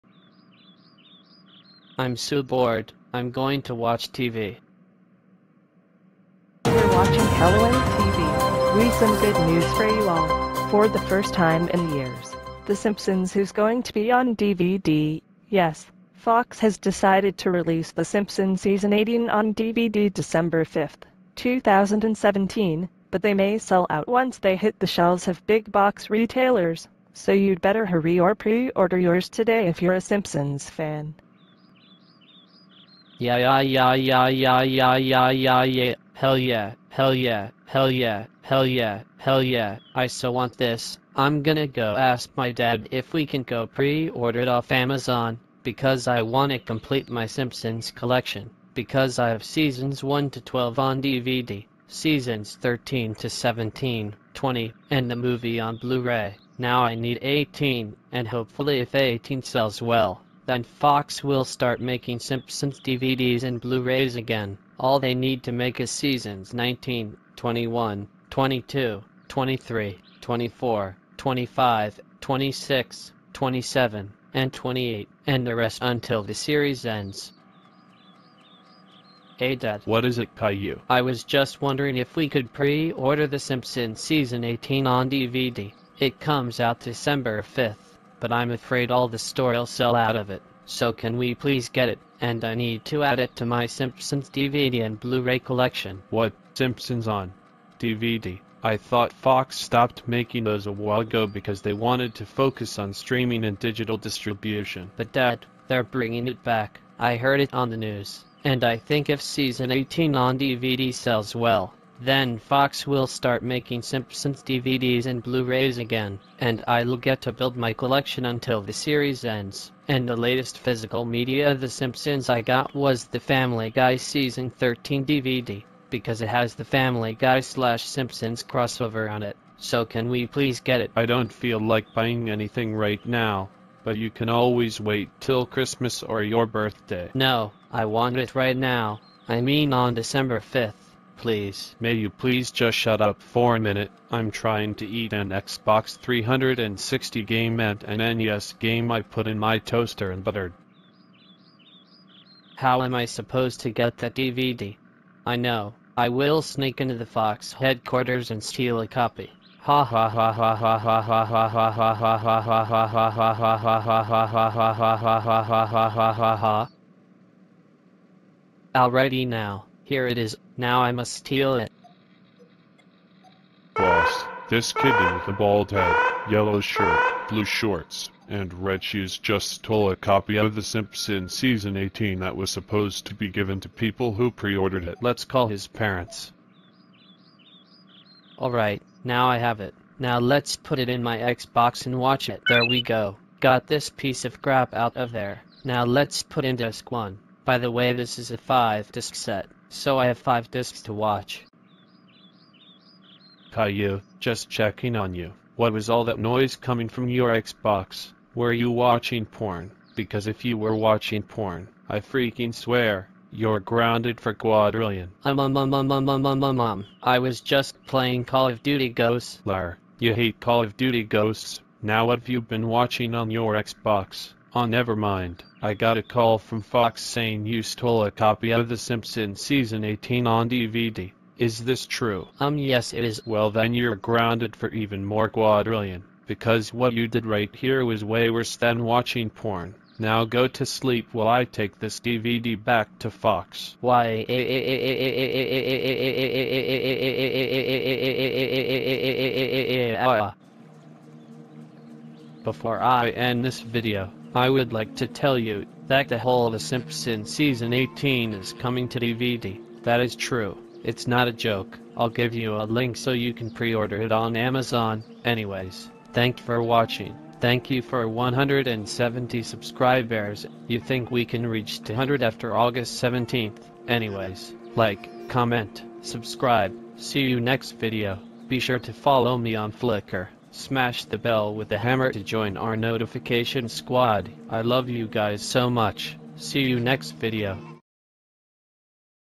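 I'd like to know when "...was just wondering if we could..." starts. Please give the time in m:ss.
1:21.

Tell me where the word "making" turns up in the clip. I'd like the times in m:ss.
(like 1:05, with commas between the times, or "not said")
1:01, 1:40, 1:53.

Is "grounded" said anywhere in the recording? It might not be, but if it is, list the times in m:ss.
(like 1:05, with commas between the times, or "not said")
3:33, 3:53.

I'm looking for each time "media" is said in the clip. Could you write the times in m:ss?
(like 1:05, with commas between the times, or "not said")
2:01.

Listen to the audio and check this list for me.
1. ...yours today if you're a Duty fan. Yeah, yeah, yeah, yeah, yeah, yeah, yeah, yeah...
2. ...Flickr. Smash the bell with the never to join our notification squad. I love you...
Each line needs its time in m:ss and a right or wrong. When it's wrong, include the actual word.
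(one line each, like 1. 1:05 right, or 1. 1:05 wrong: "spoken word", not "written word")
1. 0:28 wrong: "Simpsons", not "Duty"
2. 4:39 wrong: "hammer", not "never".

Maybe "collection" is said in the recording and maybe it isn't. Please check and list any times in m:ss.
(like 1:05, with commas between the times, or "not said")
0:47, 1:35, 1:57.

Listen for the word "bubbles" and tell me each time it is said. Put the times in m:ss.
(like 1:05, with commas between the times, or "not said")
not said.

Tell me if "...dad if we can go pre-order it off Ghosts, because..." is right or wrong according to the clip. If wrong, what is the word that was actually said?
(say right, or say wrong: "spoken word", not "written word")
wrong: "Amazon", not "Ghosts".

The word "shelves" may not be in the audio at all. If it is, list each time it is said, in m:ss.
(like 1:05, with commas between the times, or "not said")
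0:24.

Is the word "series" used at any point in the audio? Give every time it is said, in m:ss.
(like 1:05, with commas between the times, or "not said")
1:16, 1:58.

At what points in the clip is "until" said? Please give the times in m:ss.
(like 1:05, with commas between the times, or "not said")
1:15, 1:58.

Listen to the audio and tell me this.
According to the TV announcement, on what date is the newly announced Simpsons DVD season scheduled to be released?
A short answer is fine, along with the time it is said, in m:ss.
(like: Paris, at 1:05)
December 5th, 2017, at 0:20.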